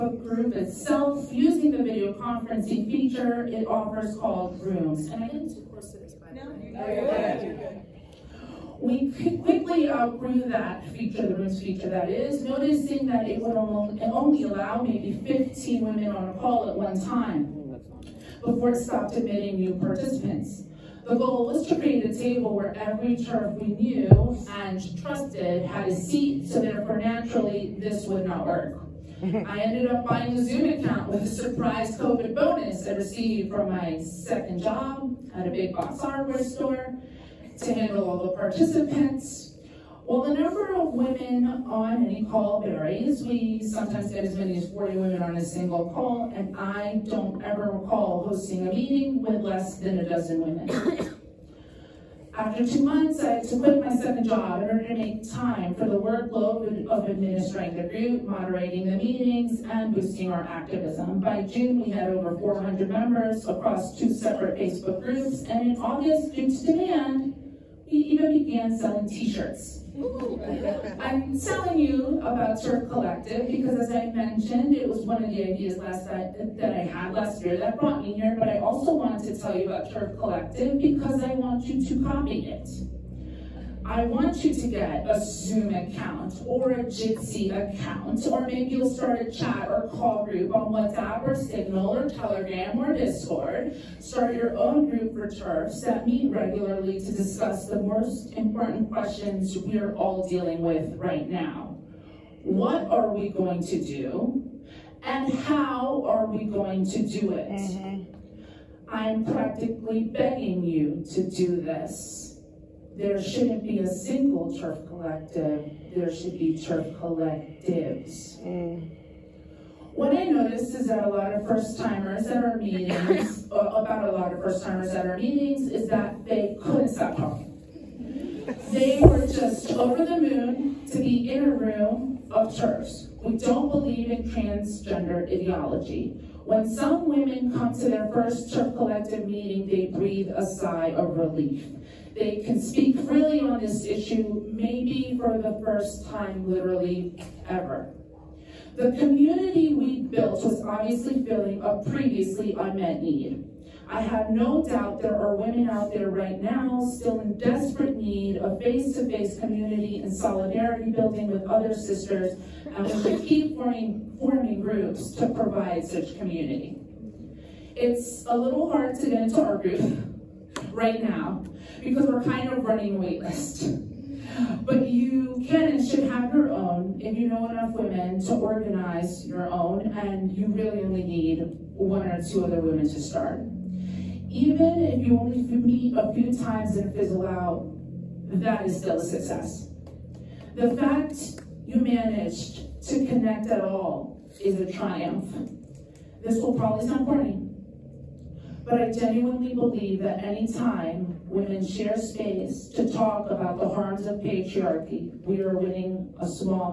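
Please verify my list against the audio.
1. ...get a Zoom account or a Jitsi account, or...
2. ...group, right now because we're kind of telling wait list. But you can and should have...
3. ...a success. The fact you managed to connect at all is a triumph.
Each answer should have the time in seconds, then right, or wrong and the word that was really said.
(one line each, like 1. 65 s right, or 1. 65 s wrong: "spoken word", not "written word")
1. 84 s right
2. 169 s wrong: "running", not "telling"
3. 188 s right.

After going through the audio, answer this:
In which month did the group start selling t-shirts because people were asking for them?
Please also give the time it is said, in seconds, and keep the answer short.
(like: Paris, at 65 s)
August, at 65 s.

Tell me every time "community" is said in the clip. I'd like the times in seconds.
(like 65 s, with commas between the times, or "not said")
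148 s, 159 s, 166 s.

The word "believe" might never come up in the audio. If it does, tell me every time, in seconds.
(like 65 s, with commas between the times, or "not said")
133 s, 199 s.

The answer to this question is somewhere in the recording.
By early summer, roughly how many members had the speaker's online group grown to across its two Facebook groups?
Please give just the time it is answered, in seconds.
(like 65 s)
62 s.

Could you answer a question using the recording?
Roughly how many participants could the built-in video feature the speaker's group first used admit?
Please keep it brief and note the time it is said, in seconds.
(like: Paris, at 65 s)
15, at 15 s.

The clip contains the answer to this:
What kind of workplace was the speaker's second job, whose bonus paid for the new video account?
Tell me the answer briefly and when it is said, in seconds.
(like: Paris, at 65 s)
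big box hardware store, at 35 s.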